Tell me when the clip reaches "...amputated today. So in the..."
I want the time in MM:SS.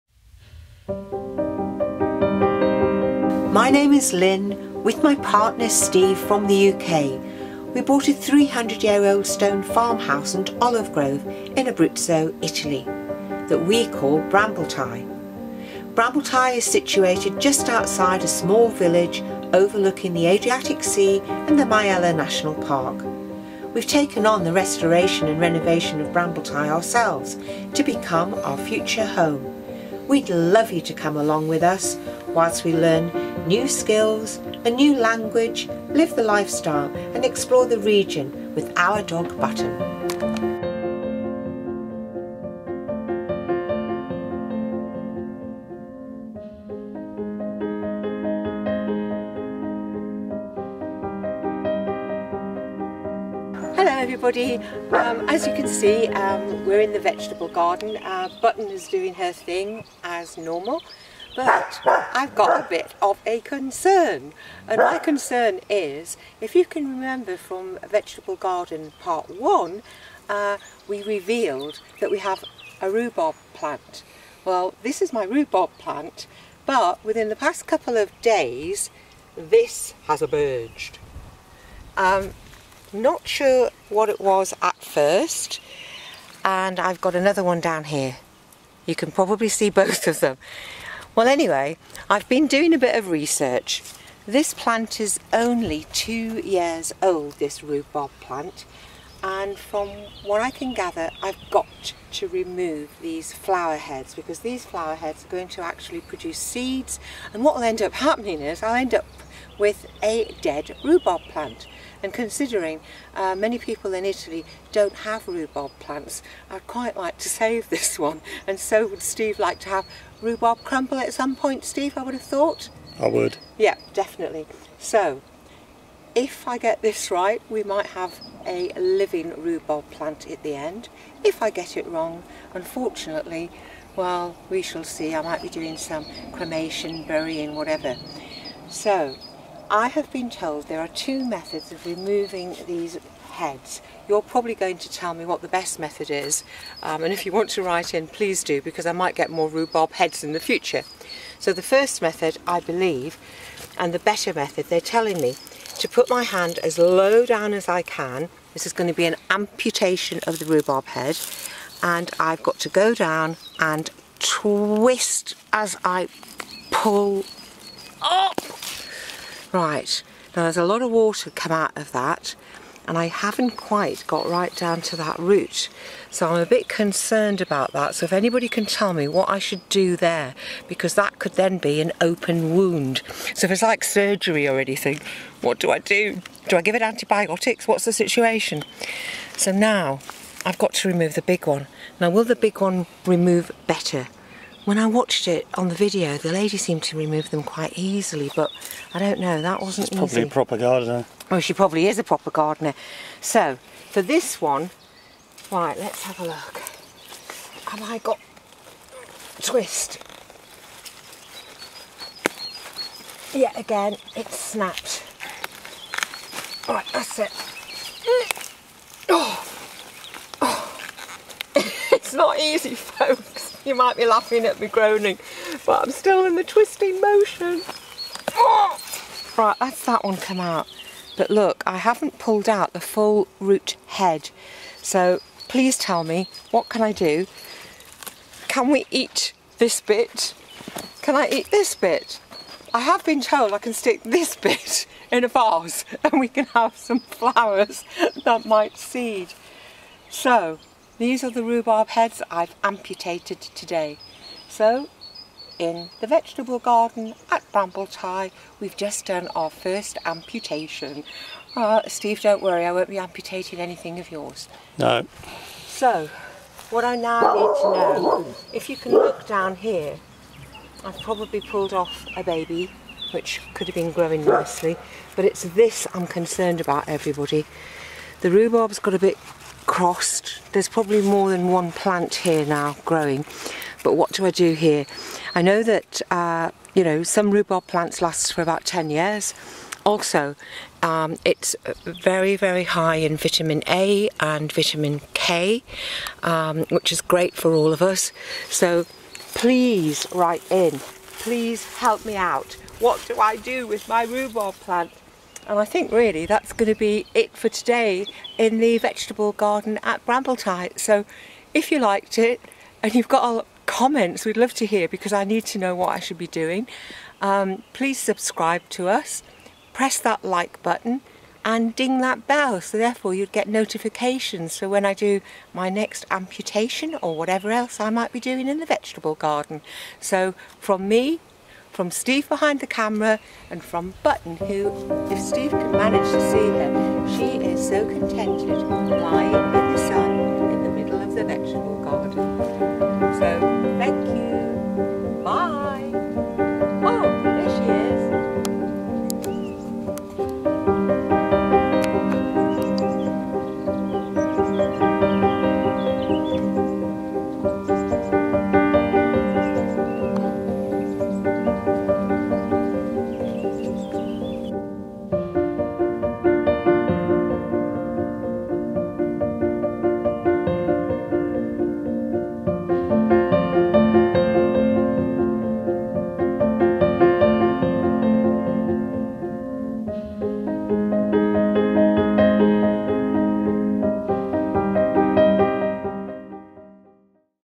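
04:12.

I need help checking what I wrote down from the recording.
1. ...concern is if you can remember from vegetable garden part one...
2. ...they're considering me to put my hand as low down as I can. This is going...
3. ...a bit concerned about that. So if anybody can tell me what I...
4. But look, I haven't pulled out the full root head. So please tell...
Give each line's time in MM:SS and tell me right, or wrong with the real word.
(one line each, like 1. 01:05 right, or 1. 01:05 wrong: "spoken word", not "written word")
1. 01:04 right
2. 02:34 wrong: "telling", not "considering"
3. 02:56 right
4. 03:51 right.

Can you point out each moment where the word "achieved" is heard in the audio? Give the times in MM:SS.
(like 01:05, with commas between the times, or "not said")
not said.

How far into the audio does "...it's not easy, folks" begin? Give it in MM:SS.
03:41.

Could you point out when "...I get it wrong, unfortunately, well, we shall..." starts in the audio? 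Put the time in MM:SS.
02:11.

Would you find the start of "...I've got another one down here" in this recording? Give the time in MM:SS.
01:26.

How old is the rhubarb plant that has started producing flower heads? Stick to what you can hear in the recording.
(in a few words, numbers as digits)
2 years.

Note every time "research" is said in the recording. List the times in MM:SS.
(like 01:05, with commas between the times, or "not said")
01:33.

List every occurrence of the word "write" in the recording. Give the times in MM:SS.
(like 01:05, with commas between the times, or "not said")
02:27, 05:00.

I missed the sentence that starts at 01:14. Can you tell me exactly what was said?
Well this is my rhubarb plant but within the past couple of days this has emerged.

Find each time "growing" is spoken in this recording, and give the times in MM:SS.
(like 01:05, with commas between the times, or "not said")
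04:33, 04:42.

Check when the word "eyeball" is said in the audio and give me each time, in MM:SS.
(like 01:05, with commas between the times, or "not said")
not said.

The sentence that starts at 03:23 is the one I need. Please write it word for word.
So, for this one, right, let's have a look.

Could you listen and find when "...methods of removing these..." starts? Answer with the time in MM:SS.
02:21.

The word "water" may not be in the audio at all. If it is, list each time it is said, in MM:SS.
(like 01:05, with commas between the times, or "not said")
02:50.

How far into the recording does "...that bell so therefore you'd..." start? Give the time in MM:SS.
05:22.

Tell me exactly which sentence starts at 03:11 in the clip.
Now will the big one remove better?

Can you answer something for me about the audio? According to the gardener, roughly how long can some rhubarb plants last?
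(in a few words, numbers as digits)
10 years.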